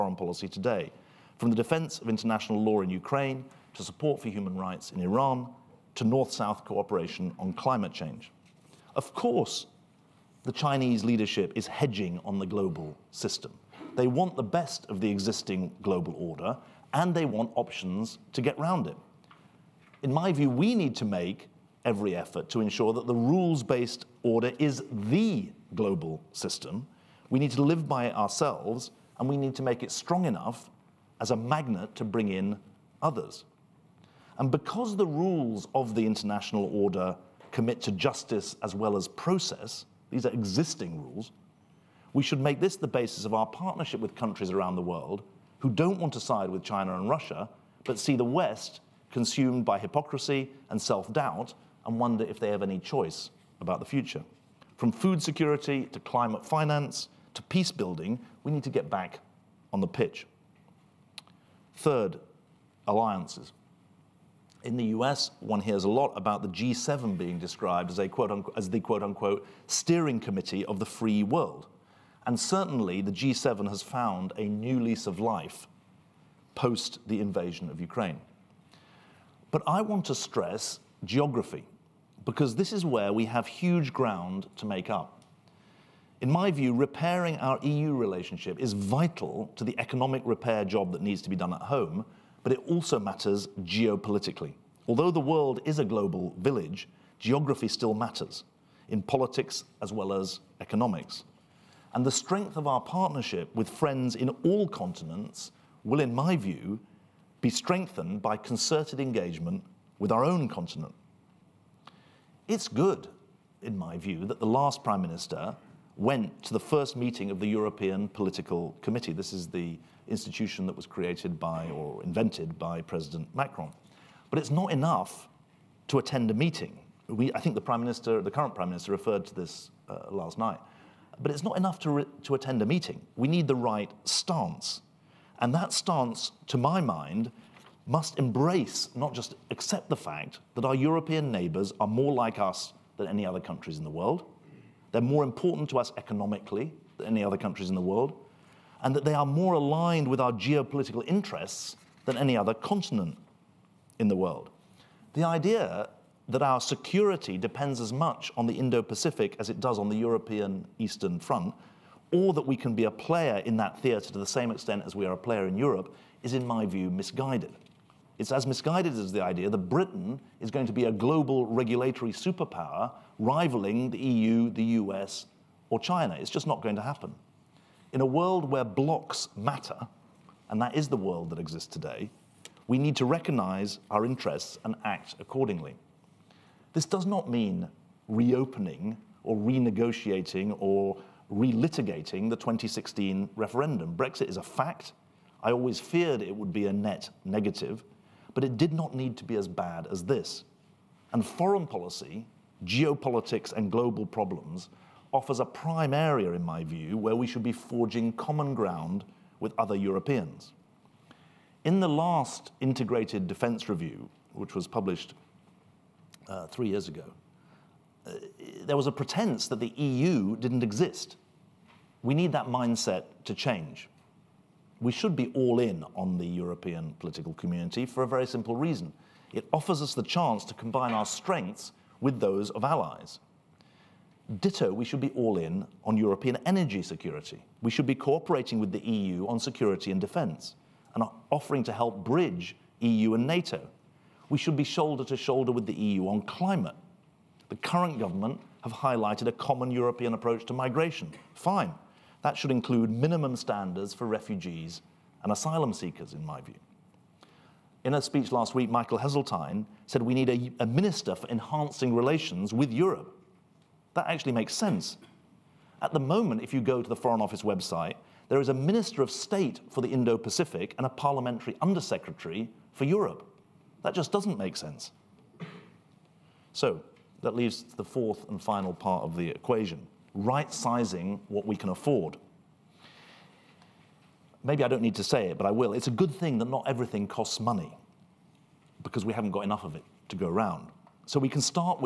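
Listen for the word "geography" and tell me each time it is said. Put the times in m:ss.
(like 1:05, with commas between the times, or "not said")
1:21, 1:37.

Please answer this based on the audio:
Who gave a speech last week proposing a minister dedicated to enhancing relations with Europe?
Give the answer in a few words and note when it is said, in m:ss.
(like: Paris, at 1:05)
Michael Heseltine, at 4:18.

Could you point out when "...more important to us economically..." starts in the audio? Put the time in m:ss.
2:25.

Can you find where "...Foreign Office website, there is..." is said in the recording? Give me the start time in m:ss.
4:26.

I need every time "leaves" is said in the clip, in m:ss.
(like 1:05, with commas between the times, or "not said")
4:37.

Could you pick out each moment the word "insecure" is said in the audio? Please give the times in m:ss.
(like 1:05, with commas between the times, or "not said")
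not said.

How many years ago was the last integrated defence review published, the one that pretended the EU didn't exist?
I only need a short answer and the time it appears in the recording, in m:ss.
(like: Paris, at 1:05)
3, at 3:36.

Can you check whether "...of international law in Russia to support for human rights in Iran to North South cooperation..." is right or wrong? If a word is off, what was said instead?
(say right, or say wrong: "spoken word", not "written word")
wrong: "Ukraine", not "Russia".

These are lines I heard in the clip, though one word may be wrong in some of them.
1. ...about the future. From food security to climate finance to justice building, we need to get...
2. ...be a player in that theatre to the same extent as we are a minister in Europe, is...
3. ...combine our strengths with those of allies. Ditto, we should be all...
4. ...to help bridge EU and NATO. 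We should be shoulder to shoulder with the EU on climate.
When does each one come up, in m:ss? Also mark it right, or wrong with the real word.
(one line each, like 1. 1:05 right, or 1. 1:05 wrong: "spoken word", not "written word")
1. 0:53 wrong: "peace", not "justice"
2. 2:42 wrong: "player", not "minister"
3. 3:50 right
4. 4:01 right.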